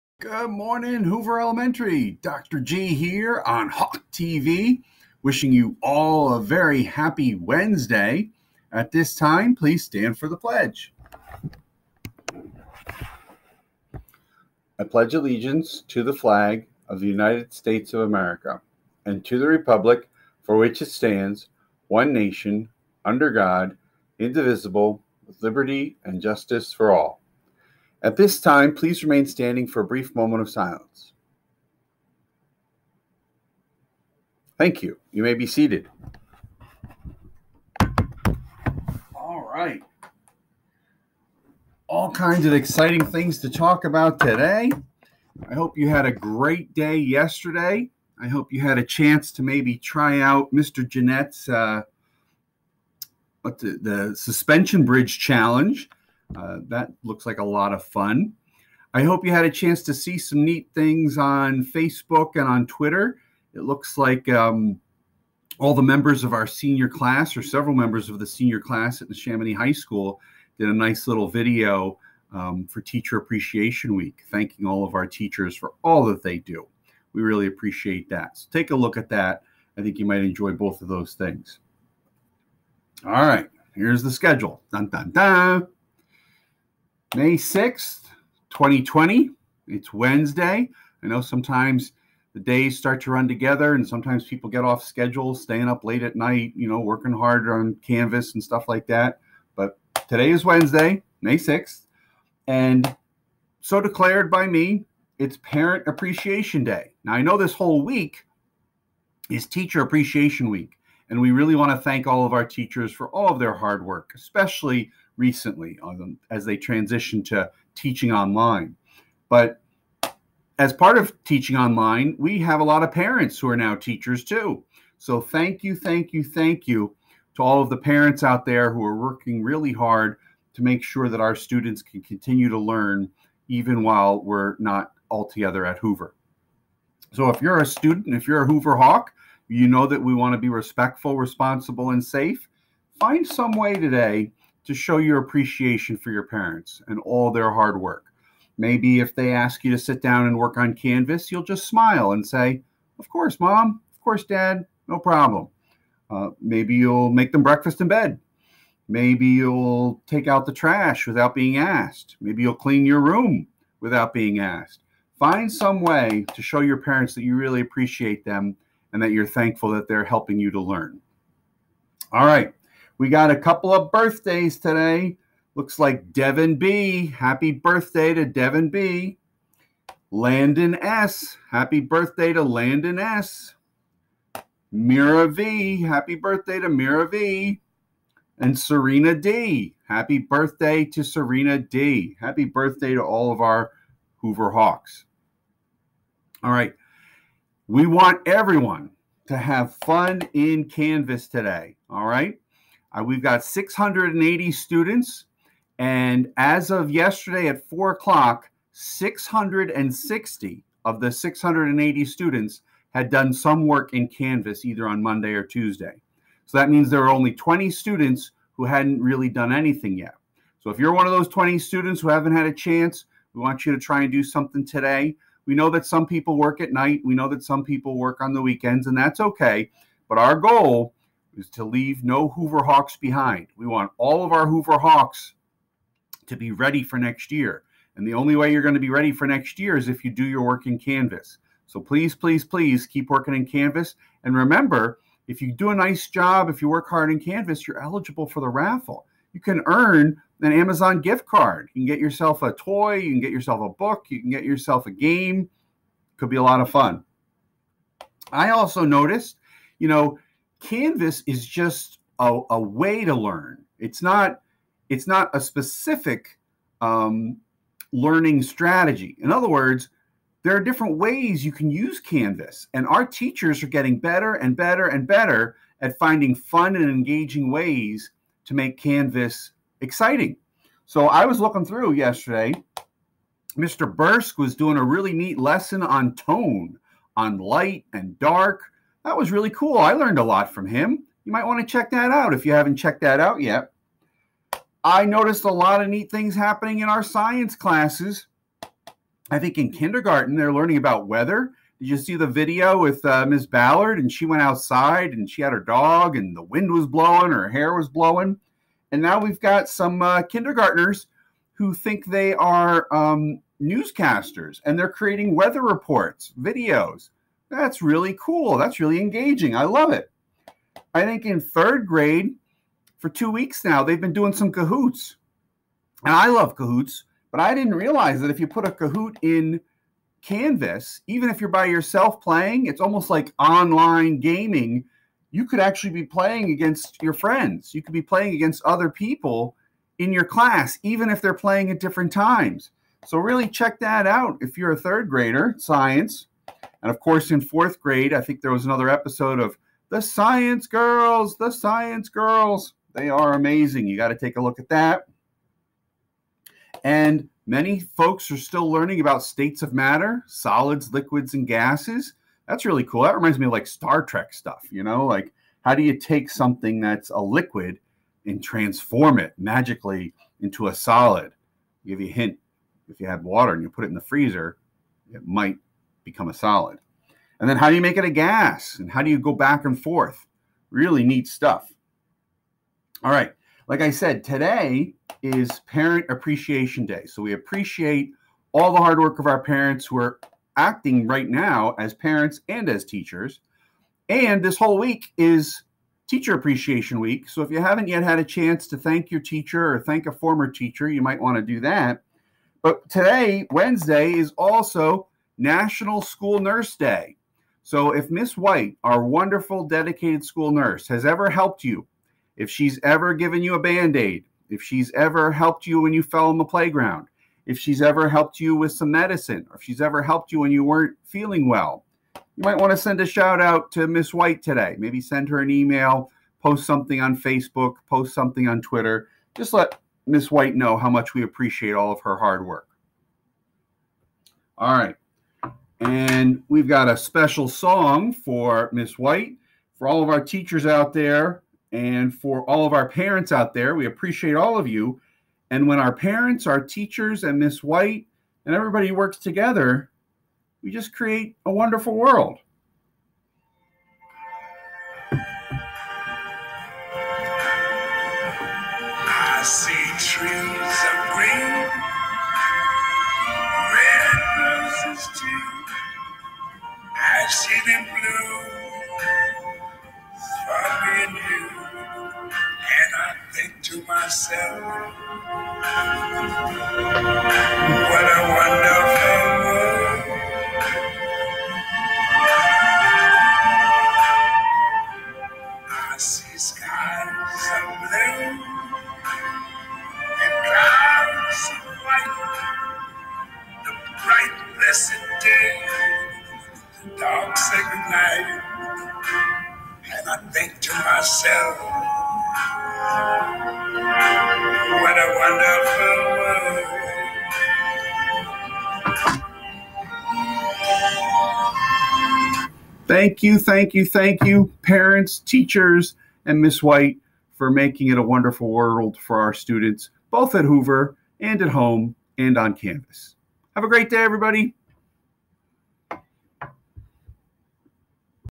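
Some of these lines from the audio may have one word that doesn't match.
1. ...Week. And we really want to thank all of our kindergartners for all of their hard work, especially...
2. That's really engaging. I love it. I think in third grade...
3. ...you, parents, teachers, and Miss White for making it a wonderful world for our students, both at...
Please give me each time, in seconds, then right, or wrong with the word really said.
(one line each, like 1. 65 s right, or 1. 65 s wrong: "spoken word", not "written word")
1. 110 s wrong: "teachers", not "kindergartners"
2. 318 s right
3. 514 s right.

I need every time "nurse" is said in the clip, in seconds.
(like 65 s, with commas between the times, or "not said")
406 s, 410 s.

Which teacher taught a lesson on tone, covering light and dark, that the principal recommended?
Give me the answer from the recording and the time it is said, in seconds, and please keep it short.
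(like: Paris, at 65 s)
Mr. Bursk, at 283 s.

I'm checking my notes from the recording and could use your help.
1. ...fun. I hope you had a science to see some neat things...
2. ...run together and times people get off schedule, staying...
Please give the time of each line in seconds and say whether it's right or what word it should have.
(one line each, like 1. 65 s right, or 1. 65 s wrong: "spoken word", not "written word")
1. 57 s wrong: "chance", not "science"
2. 93 s wrong: "sometimes", not "times".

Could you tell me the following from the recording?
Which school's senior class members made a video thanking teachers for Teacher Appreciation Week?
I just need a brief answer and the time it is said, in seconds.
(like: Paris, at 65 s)
Chamonix High School, at 69 s.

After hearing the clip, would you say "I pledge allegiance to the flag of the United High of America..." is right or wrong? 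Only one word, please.
wrong.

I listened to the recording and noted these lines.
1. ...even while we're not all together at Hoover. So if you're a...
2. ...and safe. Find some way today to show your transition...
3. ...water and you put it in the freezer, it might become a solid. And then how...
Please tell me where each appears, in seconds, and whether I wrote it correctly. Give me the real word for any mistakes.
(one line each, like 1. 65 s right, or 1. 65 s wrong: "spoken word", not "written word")
1. 133 s right
2. 141 s wrong: "appreciation", not "transition"
3. 373 s right.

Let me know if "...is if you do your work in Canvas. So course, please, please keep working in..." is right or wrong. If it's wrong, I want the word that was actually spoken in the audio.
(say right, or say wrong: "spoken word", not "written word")
wrong: "please", not "course".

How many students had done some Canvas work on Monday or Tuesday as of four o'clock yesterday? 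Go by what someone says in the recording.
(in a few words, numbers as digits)
660.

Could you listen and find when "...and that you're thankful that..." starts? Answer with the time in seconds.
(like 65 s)
168 s.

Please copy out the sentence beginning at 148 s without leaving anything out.
Maybe if they ask you to sit down and work on Canvas, you'll just smile and say, Of course, mom.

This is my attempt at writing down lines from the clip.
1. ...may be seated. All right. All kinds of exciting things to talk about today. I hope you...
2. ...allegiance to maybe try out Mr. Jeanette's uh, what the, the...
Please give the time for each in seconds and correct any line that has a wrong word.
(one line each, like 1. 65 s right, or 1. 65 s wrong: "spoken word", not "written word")
1. 35 s right
2. 48 s wrong: "chance", not "allegiance".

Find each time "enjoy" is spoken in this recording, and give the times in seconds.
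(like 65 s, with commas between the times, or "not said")
80 s.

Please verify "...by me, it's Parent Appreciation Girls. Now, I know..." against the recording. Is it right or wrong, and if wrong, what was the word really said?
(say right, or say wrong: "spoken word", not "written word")
wrong: "Day", not "Girls".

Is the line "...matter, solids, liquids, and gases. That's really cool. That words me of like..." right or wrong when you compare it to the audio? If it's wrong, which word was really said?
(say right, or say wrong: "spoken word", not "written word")
wrong: "reminds", not "words".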